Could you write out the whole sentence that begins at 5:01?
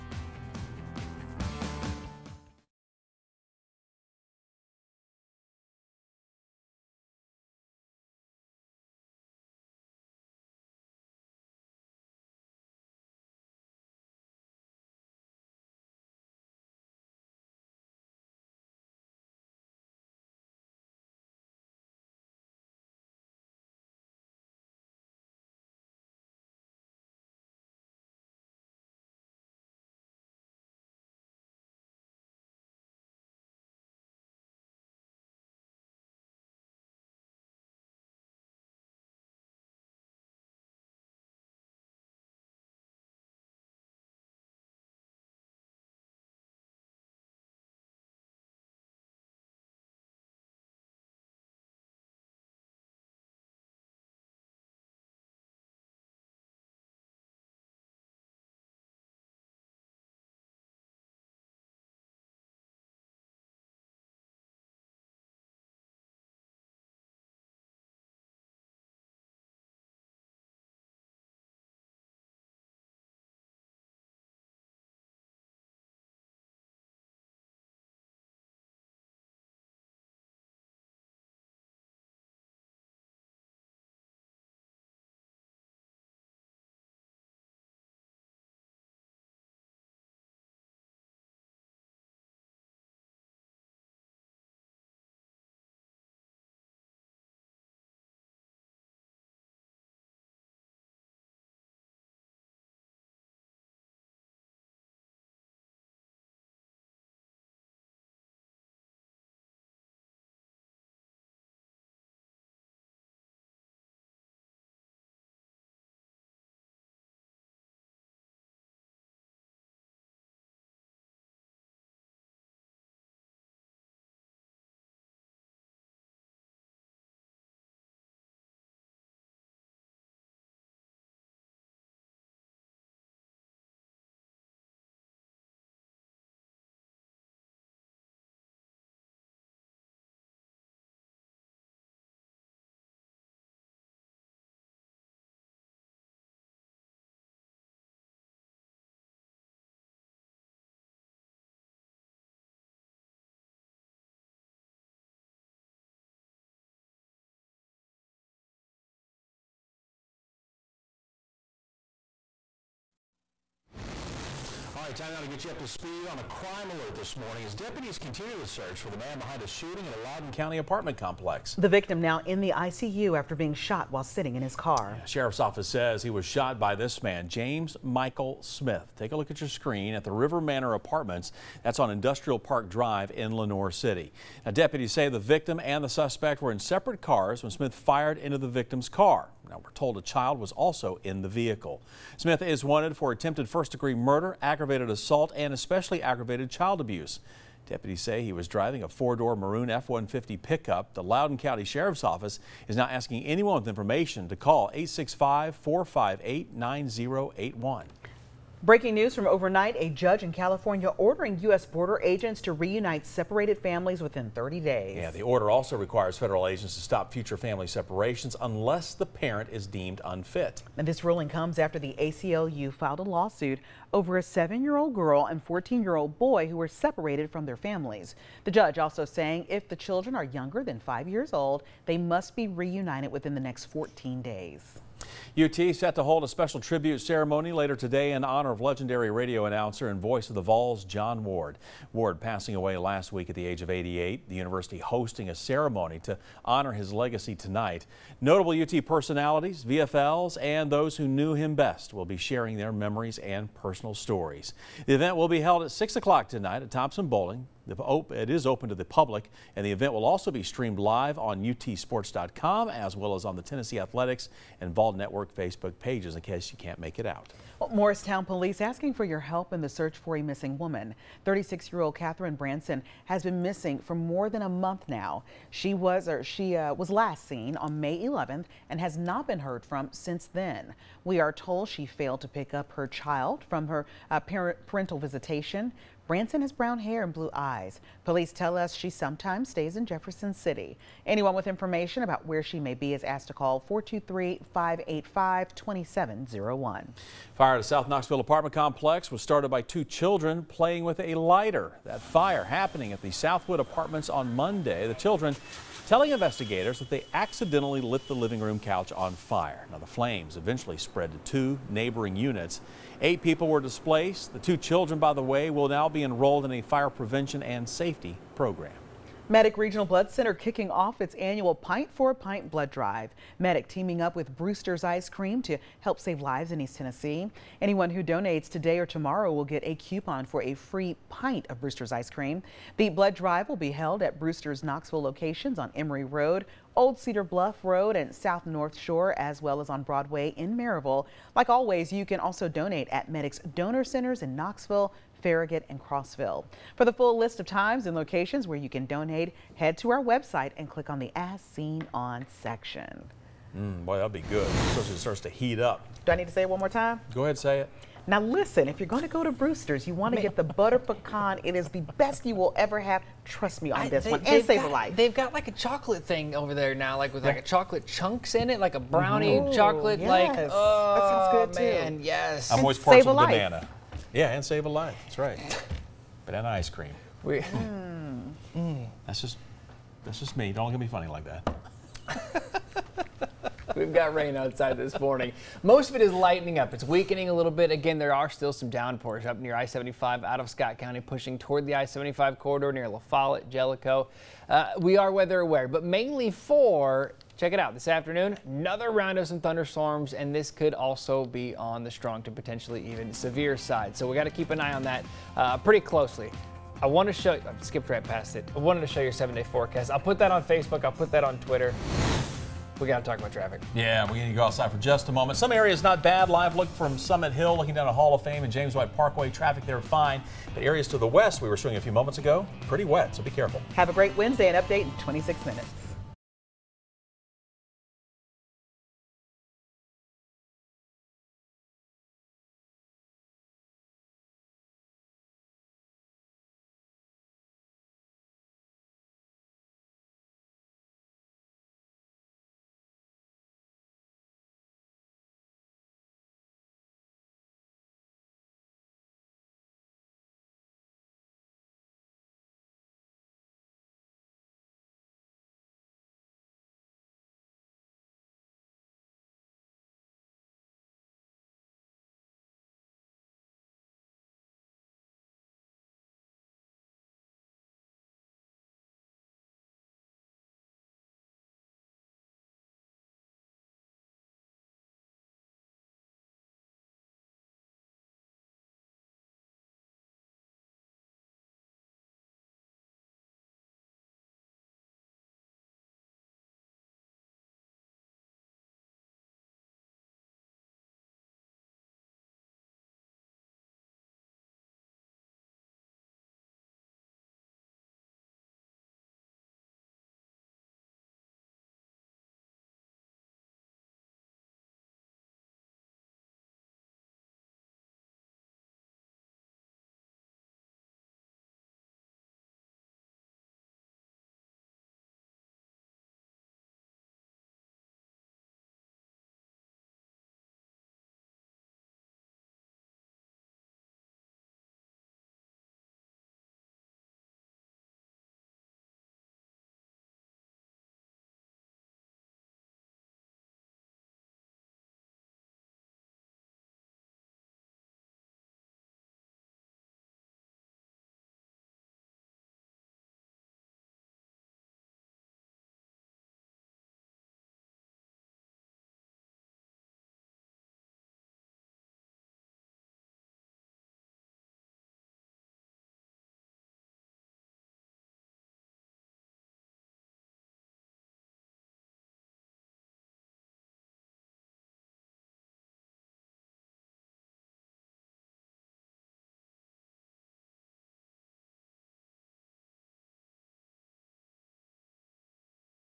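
That fire happening at the Southwood Apartments on Monday.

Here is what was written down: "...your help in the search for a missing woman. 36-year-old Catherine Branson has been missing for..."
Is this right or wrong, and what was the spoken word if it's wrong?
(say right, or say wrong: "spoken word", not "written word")
right.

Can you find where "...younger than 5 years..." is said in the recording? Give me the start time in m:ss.
3:50.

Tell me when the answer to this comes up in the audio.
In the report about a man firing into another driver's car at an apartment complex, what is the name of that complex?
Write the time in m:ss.
3:00.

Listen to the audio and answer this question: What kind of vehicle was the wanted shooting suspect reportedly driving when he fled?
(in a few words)
Maroon F-150 pickup.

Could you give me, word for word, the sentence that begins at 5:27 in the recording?
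Anyone who donates today or tomorrow will get a coupon for a free pint of Brewster's Ice Cream.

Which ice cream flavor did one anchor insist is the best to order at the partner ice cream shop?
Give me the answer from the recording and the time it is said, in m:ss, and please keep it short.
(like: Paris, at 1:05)
Butter pecan, at 6:00.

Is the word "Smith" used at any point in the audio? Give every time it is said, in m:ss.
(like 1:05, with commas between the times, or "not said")
2:58, 3:07, 3:12.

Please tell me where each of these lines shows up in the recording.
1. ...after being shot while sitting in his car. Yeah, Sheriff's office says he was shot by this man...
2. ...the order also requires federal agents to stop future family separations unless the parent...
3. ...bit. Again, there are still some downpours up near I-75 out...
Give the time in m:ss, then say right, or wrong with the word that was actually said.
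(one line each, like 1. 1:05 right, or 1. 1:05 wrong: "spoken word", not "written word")
1. 2:53 right
2. 3:35 right
3. 6:27 right.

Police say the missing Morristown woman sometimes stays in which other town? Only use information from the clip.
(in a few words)
Jefferson City.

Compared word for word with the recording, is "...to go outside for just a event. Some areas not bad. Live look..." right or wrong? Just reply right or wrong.
wrong.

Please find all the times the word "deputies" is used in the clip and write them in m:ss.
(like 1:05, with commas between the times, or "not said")
2:47, 3:04, 3:17.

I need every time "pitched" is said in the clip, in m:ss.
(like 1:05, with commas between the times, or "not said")
not said.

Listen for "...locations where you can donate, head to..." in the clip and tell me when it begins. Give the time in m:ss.
5:47.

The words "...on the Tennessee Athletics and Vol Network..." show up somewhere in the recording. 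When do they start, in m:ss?
4:23.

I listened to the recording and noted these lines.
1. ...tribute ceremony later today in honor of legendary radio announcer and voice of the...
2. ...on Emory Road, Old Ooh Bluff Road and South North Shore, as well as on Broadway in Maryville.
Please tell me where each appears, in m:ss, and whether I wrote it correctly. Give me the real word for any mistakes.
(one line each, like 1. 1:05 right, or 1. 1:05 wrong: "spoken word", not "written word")
1. 3:56 right
2. 5:35 wrong: "Cedar", not "Ooh".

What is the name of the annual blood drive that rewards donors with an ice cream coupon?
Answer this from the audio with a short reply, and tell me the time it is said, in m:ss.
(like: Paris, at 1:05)
Pint for a Pint, at 5:21.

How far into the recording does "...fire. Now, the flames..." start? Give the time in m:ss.
5:09.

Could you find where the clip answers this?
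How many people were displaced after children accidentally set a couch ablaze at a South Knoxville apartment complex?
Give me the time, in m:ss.
5:13.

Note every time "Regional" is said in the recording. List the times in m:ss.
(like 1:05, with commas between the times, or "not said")
5:19.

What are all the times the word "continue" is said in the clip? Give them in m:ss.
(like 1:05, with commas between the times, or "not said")
2:47.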